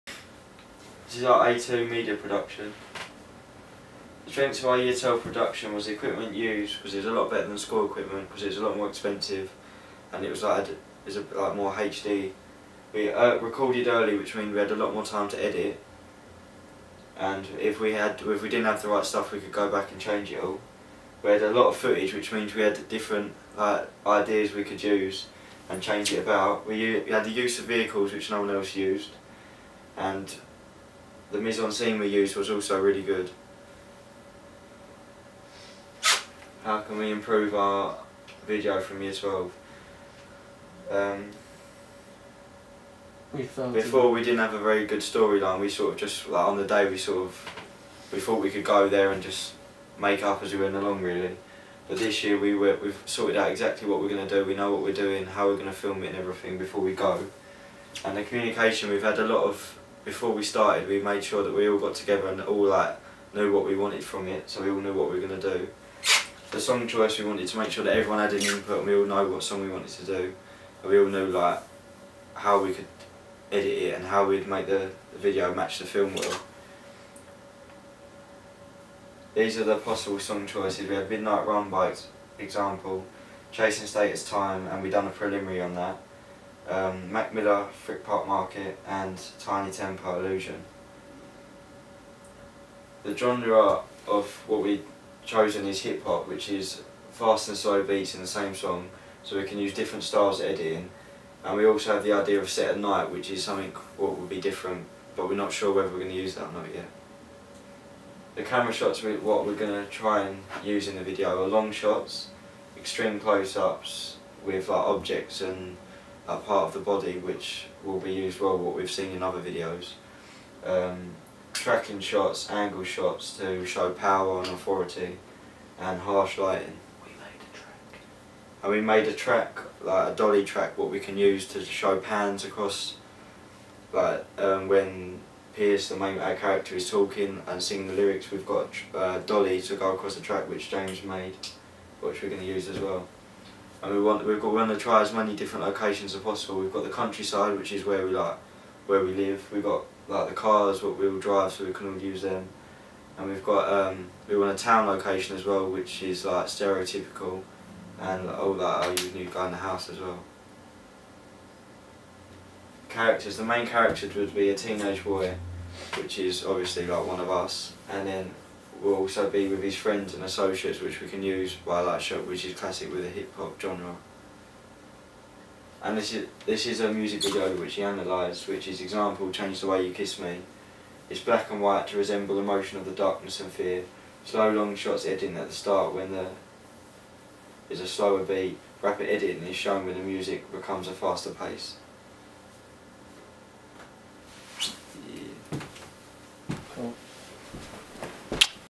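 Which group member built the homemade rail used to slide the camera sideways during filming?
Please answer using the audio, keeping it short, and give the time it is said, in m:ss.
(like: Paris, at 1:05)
James, at 2:20.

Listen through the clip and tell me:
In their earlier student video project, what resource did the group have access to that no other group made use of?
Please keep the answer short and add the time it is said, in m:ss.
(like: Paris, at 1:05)
vehicles, at 0:27.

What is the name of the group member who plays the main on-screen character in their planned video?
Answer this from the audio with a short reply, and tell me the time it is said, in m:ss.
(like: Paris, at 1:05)
Pearce, at 2:15.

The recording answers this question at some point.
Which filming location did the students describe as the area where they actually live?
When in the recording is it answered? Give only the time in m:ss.
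2:26.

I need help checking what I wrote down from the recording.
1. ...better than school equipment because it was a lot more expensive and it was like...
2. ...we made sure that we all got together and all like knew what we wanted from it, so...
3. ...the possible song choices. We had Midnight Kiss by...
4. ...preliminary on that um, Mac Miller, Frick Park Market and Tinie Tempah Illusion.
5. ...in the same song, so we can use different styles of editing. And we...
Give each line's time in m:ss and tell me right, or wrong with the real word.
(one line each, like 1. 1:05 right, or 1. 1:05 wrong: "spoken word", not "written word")
1. 0:07 right
2. 1:00 right
3. 1:19 wrong: "Run", not "Kiss"
4. 1:25 right
5. 1:38 right.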